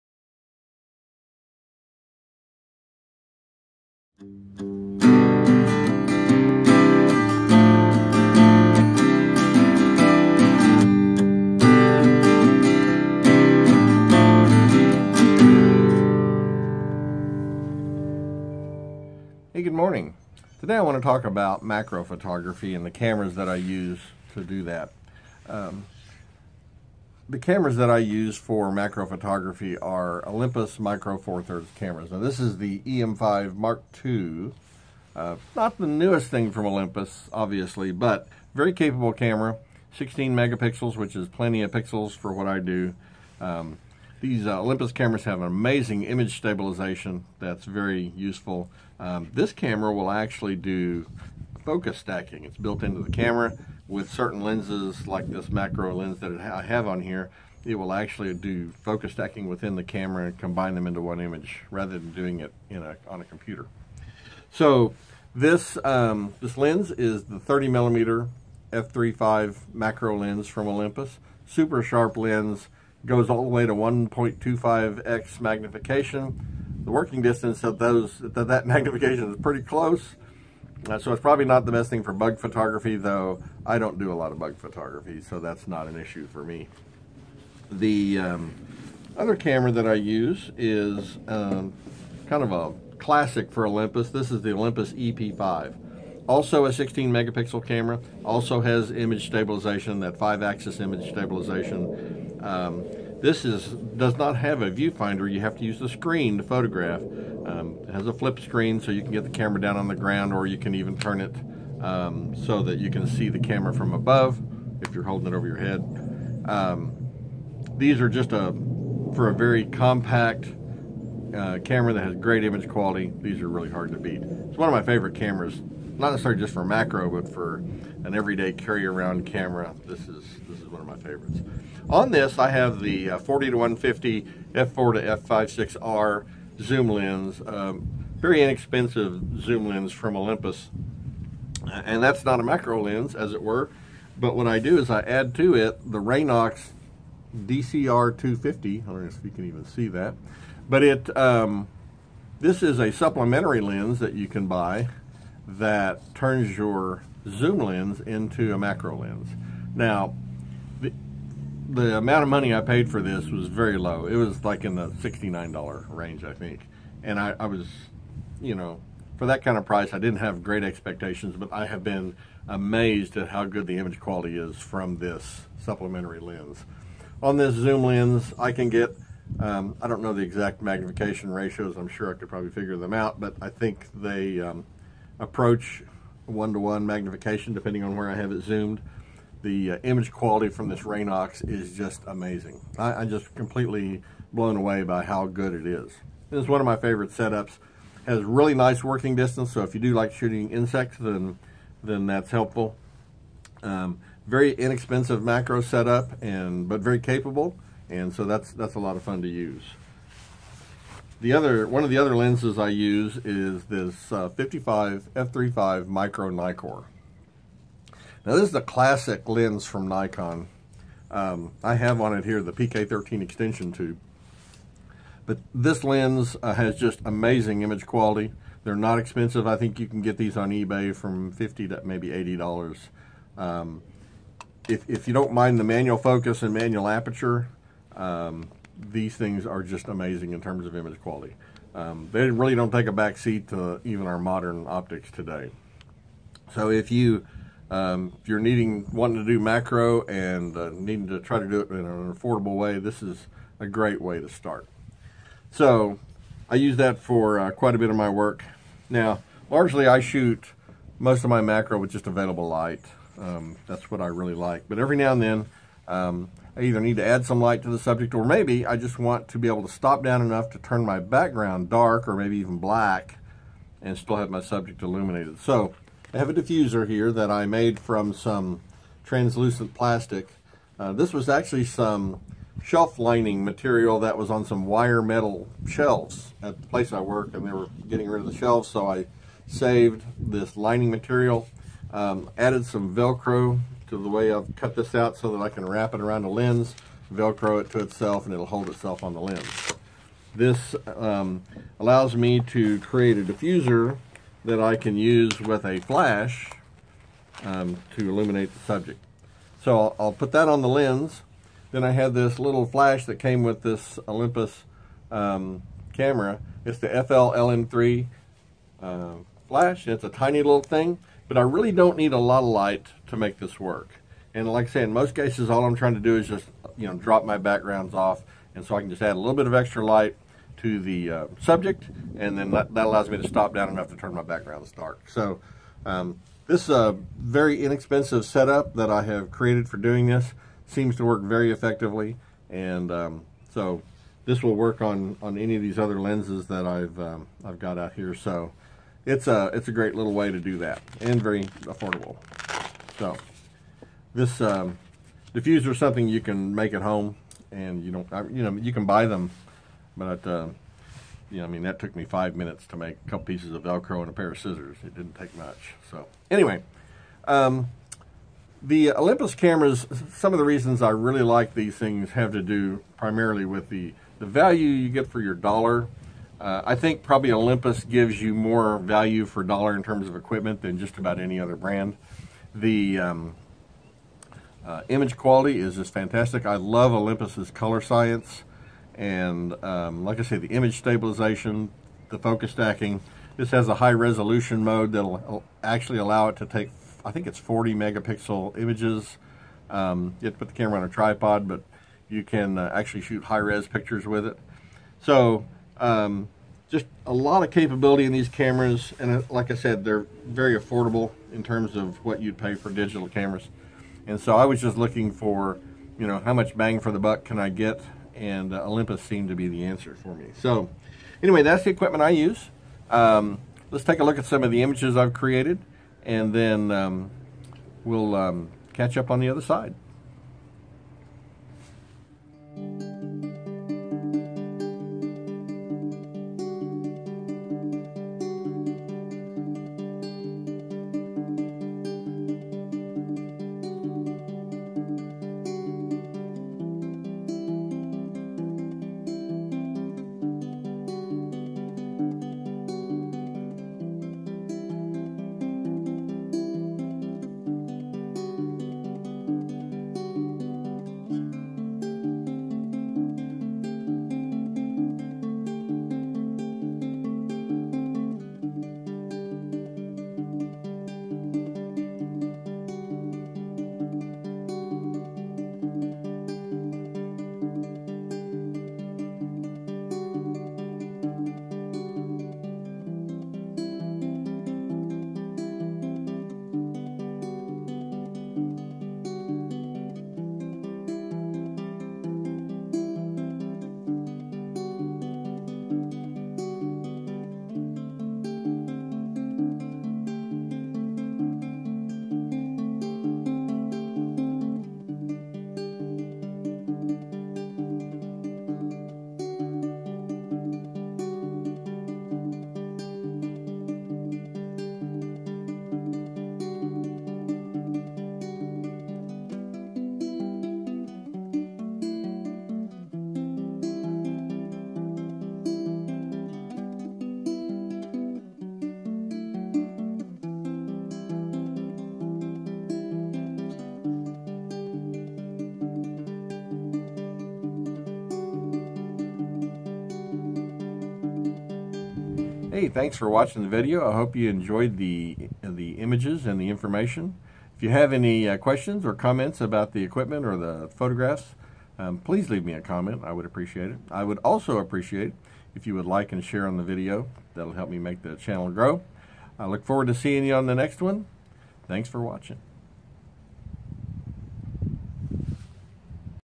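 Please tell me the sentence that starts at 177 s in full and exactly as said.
On this zoom lens, I can get um, I don't know the exact magnification ratios.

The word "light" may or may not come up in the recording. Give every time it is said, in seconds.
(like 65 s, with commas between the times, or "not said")
262 s, 267 s, 322 s, 329 s.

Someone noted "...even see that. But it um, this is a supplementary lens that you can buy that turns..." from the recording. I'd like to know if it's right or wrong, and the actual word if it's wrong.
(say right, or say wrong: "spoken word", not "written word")
right.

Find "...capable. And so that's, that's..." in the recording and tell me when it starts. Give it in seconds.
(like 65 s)
206 s.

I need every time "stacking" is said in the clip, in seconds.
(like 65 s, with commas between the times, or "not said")
51 s, 59 s, 392 s.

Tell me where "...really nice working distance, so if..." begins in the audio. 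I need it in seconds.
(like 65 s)
198 s.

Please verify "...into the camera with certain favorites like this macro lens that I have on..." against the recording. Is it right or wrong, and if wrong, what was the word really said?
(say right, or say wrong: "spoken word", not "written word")
wrong: "lenses", not "favorites".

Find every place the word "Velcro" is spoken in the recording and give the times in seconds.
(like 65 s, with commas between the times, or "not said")
292 s, 297 s, 363 s.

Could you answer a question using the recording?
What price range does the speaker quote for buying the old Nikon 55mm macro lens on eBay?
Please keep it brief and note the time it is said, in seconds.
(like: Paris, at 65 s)
$50 to $80, at 231 s.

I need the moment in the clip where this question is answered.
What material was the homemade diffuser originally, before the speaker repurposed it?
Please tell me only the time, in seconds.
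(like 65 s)
282 s.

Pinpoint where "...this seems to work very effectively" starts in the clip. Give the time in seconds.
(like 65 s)
340 s.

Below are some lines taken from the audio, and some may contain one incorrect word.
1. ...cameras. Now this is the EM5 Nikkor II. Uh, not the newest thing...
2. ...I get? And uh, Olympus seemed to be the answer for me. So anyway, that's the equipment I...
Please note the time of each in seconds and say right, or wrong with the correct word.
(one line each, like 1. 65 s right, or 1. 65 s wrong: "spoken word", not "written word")
1. 31 s wrong: "Mark", not "Nikkor"
2. 417 s right.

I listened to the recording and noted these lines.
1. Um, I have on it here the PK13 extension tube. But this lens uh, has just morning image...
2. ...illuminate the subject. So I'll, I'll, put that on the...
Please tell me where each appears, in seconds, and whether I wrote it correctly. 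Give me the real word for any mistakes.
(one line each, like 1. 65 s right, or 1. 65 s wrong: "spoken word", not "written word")
1. 221 s wrong: "amazing", not "morning"
2. 308 s right.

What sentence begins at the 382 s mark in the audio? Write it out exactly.
The um, uh, image quality is just fantastic.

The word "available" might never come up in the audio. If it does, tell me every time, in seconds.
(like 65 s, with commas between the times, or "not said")
262 s.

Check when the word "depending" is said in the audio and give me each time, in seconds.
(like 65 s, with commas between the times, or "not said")
187 s.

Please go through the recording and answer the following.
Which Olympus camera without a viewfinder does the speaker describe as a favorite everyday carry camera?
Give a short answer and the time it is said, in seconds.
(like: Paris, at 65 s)
Olympus EP5, at 94 s.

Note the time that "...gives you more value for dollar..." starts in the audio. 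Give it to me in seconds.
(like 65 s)
377 s.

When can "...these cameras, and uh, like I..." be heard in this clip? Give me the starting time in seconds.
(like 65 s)
408 s.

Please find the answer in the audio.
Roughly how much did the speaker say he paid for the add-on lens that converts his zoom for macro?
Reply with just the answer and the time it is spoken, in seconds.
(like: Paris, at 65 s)
$69, at 164 s.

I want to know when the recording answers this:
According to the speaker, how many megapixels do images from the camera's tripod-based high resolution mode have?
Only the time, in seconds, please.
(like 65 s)
397 s.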